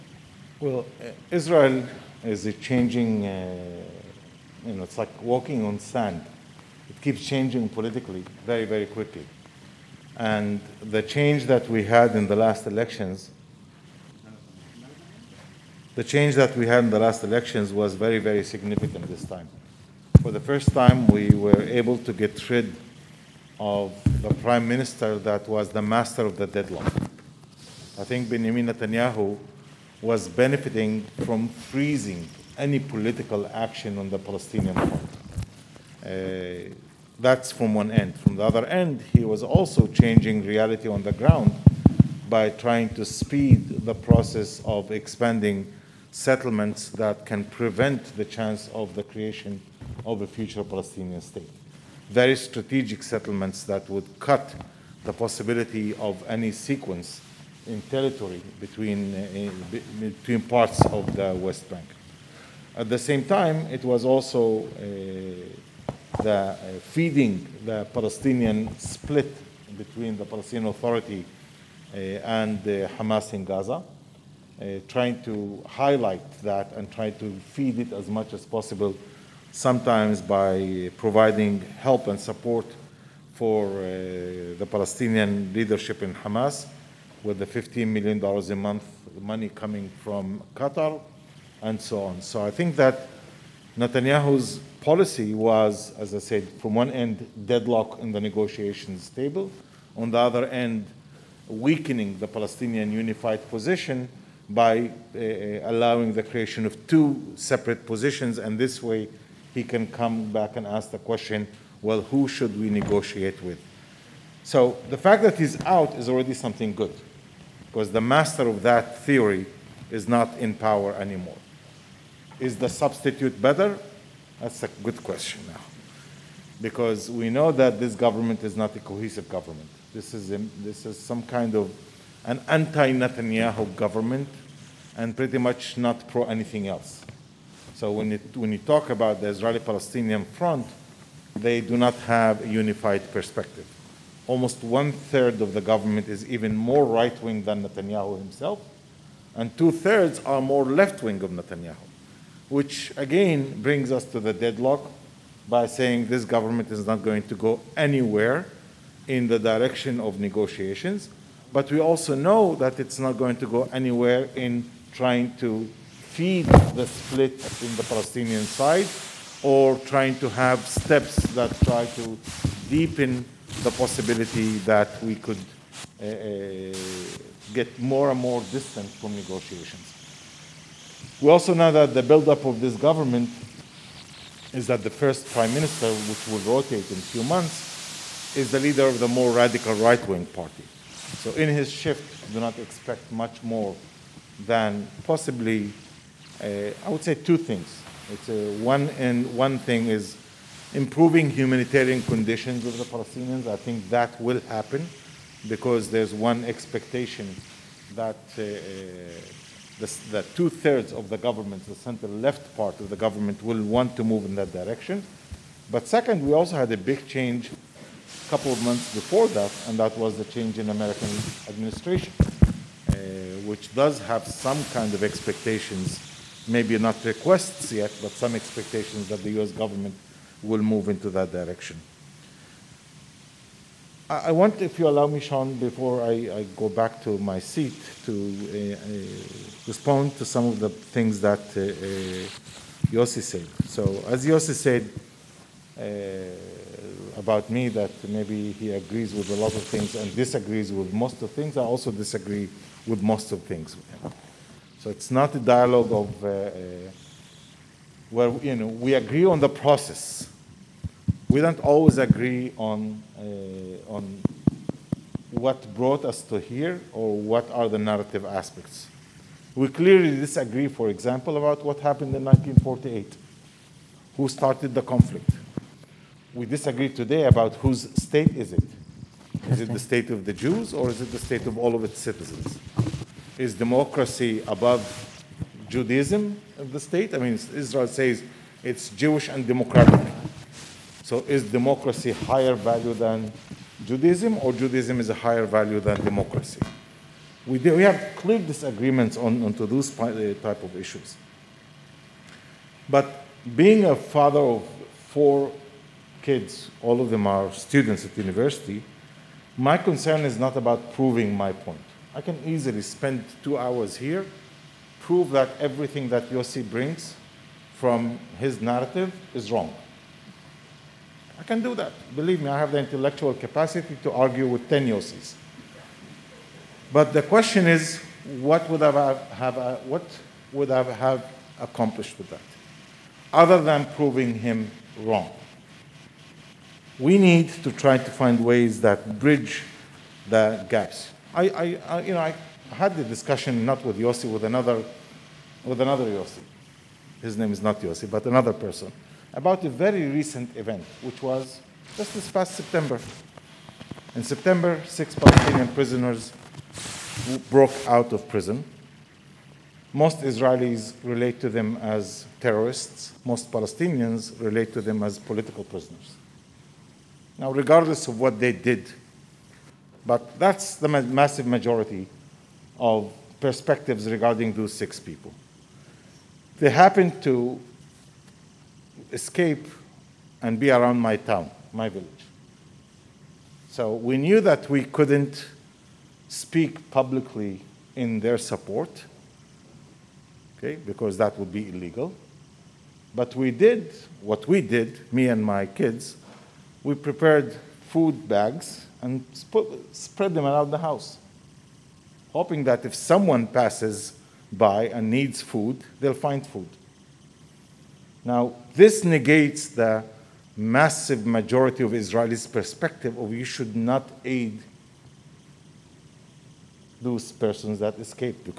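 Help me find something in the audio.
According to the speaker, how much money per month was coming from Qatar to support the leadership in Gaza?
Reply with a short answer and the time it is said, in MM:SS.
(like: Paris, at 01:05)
$15 million, at 01:27.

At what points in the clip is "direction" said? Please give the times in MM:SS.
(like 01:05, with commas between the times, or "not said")
02:39, 03:34, 03:51.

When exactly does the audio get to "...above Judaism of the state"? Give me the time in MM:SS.
04:44.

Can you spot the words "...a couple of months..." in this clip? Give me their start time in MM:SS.
03:37.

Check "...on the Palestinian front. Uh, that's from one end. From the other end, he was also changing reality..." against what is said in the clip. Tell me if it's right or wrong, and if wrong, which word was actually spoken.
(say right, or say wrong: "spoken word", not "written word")
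right.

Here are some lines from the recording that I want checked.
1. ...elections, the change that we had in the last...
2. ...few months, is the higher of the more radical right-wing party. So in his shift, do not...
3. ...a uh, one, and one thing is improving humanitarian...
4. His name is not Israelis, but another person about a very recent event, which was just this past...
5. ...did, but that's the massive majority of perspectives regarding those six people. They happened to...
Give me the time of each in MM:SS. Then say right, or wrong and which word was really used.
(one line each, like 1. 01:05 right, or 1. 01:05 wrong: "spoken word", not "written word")
1. 00:12 right
2. 03:07 wrong: "leader", not "higher"
3. 03:18 right
4. 05:47 wrong: "Yossi", not "Israelis"
5. 06:08 right.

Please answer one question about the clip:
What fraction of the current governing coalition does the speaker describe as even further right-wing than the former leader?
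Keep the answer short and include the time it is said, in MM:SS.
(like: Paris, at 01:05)
one-third, at 02:24.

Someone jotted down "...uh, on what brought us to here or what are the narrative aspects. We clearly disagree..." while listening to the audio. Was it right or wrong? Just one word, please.
right.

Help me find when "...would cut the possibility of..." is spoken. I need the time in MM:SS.
00:53.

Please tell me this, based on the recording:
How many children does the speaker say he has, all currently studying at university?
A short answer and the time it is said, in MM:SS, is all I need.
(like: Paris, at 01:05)
4, at 05:05.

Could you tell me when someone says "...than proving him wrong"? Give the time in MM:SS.
05:33.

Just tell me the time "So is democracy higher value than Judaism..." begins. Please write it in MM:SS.
04:51.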